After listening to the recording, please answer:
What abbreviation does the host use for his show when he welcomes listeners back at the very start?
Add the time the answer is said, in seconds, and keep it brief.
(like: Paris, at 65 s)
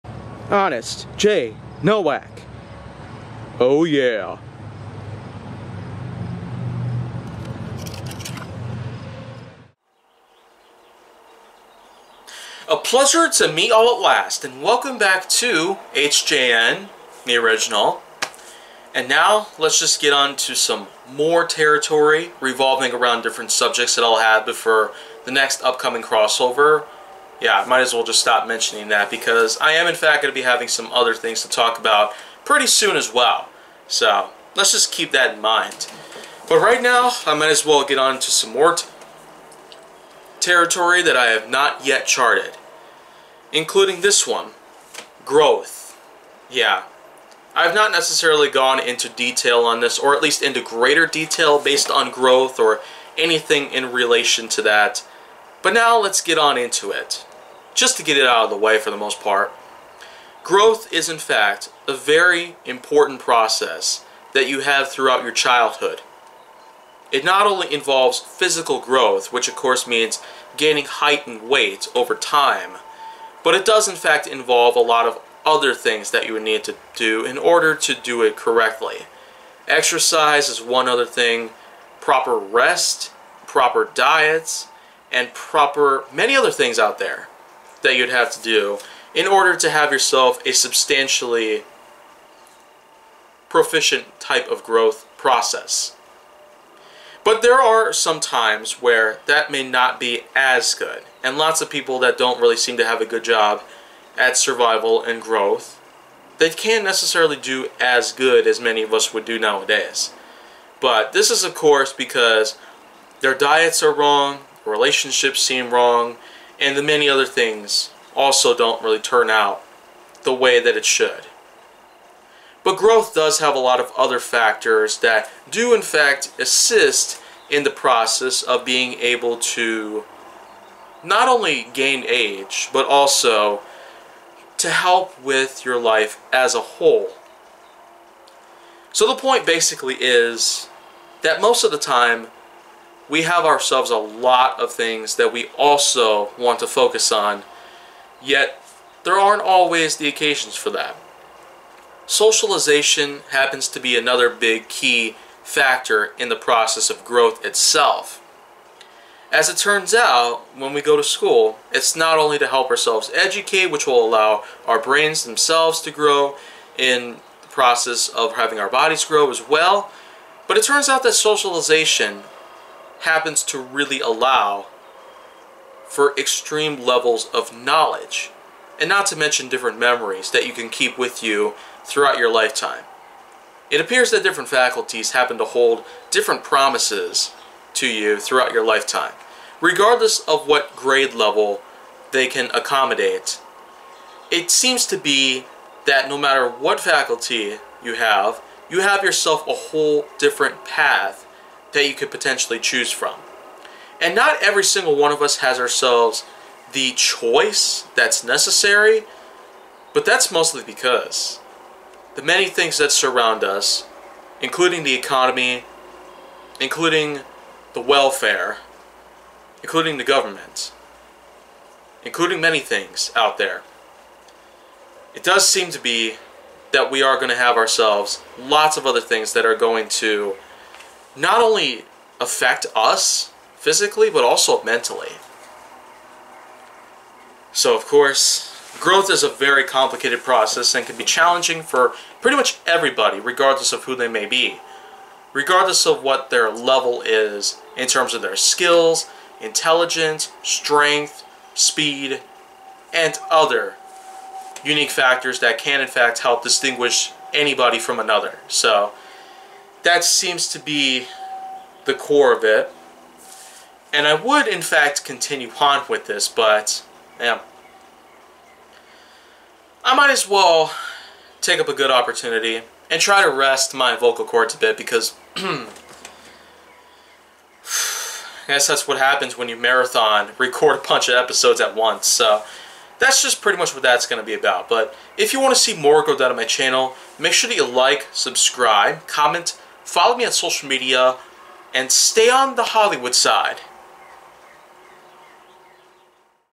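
HJN, at 15 s.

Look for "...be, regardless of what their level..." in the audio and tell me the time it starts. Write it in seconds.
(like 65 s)
244 s.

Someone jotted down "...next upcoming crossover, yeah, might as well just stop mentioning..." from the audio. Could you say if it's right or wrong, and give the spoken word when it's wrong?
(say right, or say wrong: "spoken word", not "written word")
right.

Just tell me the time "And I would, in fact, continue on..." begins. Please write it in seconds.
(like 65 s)
263 s.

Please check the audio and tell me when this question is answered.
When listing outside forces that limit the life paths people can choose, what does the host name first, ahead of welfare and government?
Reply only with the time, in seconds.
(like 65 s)
214 s.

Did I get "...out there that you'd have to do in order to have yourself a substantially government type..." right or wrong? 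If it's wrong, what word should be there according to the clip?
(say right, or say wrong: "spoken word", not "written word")
wrong: "proficient", not "government".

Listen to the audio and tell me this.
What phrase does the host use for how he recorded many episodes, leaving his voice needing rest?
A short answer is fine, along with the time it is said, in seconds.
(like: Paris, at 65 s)
marathon record, at 279 s.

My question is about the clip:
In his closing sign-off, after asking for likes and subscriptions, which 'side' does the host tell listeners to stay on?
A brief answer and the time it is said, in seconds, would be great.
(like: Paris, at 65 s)
Hollywood side, at 292 s.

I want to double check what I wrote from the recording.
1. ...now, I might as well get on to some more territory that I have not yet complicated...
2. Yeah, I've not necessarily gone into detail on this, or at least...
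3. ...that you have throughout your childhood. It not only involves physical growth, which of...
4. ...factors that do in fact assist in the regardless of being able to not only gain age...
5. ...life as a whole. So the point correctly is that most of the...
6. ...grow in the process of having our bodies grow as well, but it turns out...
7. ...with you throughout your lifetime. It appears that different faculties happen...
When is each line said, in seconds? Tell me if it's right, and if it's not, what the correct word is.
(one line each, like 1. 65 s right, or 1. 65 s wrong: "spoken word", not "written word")
1. 36 s wrong: "charted", not "complicated"
2. 46 s right
3. 64 s right
4. 124 s wrong: "process", not "regardless"
5. 135 s wrong: "basically", not "correctly"
6. 165 s right
7. 180 s right.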